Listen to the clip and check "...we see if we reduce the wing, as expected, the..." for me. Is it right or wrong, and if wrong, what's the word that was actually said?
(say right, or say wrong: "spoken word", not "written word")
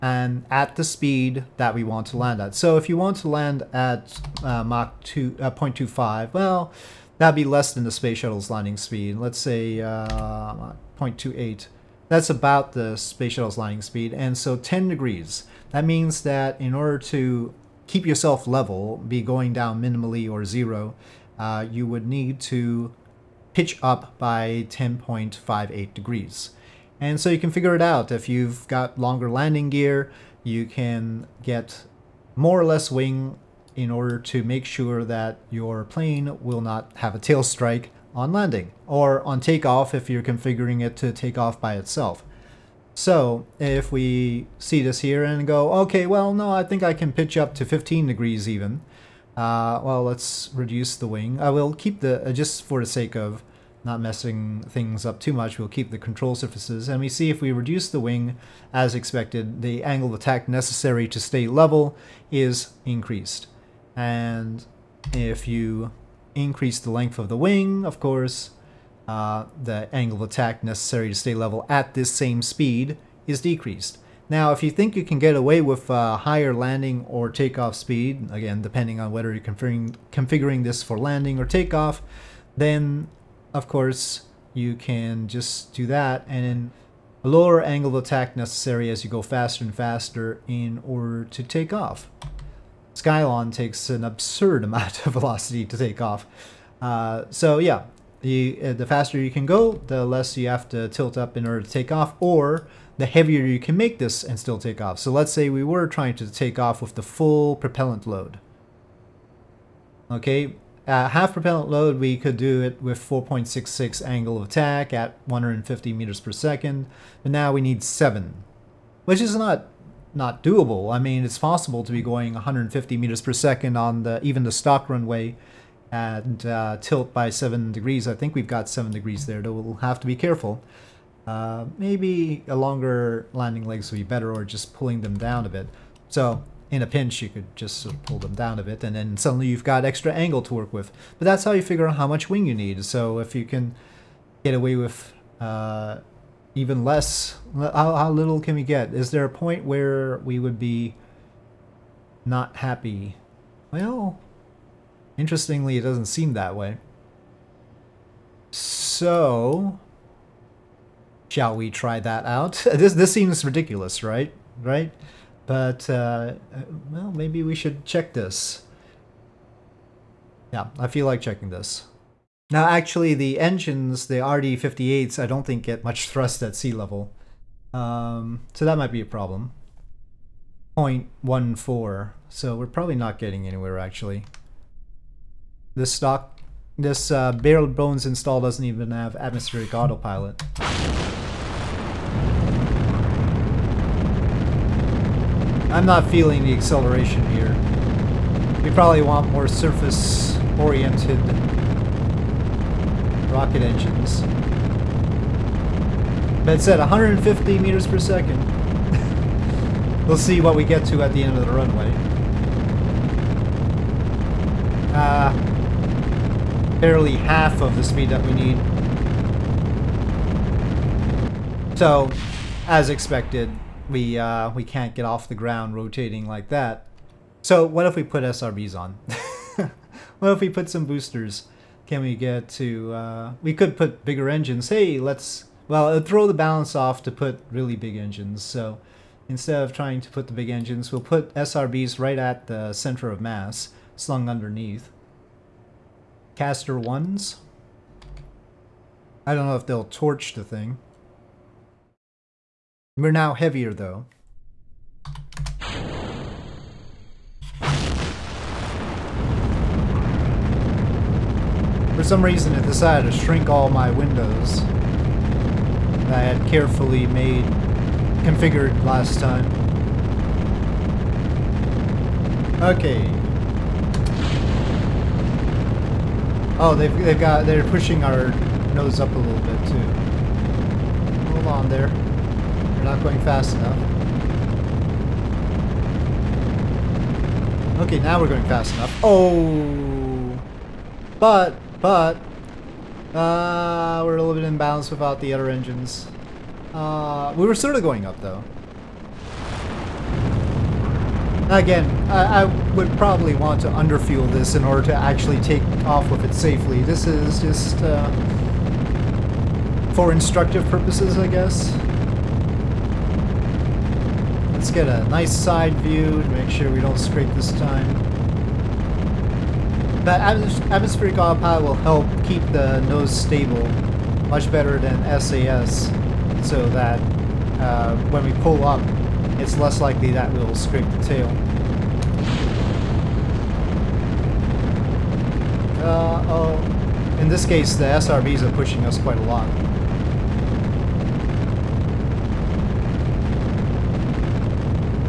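right.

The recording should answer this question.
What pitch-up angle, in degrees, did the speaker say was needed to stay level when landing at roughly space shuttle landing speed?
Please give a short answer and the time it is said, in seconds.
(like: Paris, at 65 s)
10.58 degrees, at 24 s.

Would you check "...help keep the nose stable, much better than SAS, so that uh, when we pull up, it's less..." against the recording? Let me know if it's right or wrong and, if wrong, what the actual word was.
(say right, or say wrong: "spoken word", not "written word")
right.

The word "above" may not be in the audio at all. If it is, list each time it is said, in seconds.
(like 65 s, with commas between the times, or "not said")
not said.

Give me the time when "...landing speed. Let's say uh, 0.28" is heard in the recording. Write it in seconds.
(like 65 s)
8 s.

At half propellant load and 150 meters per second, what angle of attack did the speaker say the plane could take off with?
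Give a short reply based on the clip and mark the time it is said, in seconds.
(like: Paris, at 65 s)
4.66, at 112 s.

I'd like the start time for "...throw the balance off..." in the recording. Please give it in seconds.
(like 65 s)
236 s.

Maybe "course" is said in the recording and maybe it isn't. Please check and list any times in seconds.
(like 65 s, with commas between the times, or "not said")
67 s, 83 s.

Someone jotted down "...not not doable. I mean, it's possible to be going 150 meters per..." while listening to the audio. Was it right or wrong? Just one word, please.
right.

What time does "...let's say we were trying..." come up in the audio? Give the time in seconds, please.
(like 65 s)
105 s.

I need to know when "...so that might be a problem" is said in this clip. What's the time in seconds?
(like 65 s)
178 s.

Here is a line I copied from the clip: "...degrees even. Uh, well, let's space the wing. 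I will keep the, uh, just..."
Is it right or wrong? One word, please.
wrong.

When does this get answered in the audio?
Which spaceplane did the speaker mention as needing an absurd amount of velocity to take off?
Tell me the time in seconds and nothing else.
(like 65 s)
92 s.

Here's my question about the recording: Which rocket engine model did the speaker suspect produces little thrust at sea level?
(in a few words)
RD-58.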